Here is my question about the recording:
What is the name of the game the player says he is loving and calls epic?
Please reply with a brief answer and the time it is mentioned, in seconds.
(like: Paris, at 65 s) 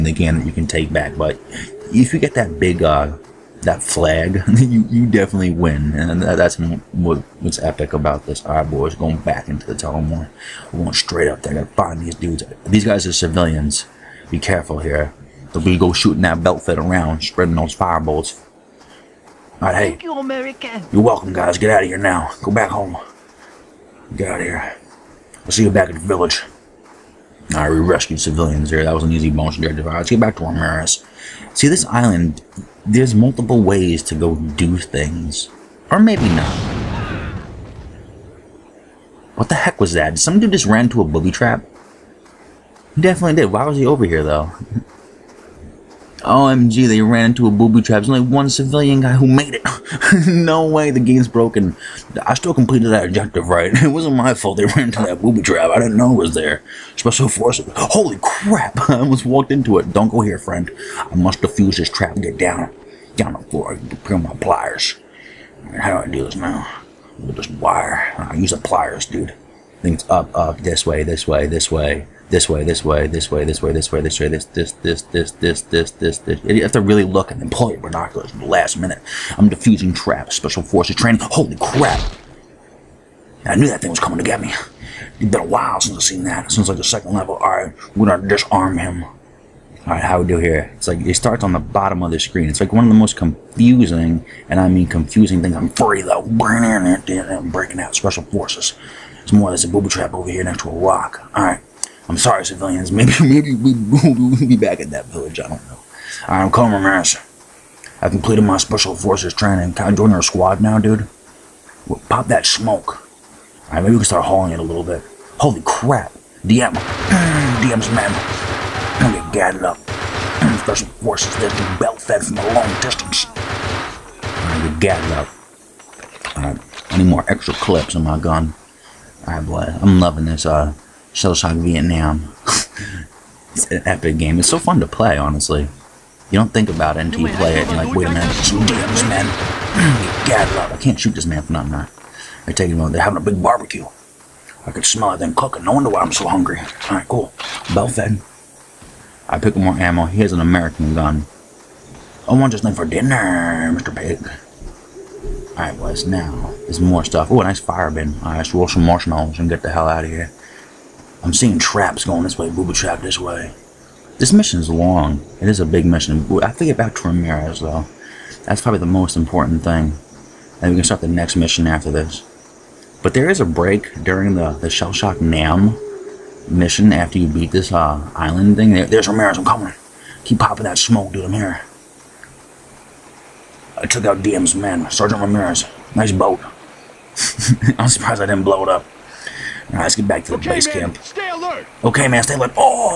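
Shell Shock Vietnam, at 131 s.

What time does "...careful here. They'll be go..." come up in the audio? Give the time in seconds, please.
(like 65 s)
14 s.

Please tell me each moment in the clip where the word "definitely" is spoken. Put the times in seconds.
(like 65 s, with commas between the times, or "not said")
5 s, 43 s.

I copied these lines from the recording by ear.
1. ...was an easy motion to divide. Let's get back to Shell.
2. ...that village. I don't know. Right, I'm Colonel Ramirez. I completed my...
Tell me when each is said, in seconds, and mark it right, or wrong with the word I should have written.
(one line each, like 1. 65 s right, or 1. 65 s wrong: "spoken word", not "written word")
1. 28 s wrong: "Ramirez", not "Shell"
2. 104 s right.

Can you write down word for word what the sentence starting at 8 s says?
Our boys going back into the Tullamore.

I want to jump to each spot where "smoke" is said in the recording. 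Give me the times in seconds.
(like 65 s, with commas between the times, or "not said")
112 s, 180 s.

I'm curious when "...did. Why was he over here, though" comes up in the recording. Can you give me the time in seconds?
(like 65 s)
43 s.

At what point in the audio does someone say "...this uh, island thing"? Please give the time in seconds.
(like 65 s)
177 s.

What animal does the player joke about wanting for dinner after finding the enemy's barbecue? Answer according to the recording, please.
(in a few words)
Pig.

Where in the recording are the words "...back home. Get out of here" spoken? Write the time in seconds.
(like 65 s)
22 s.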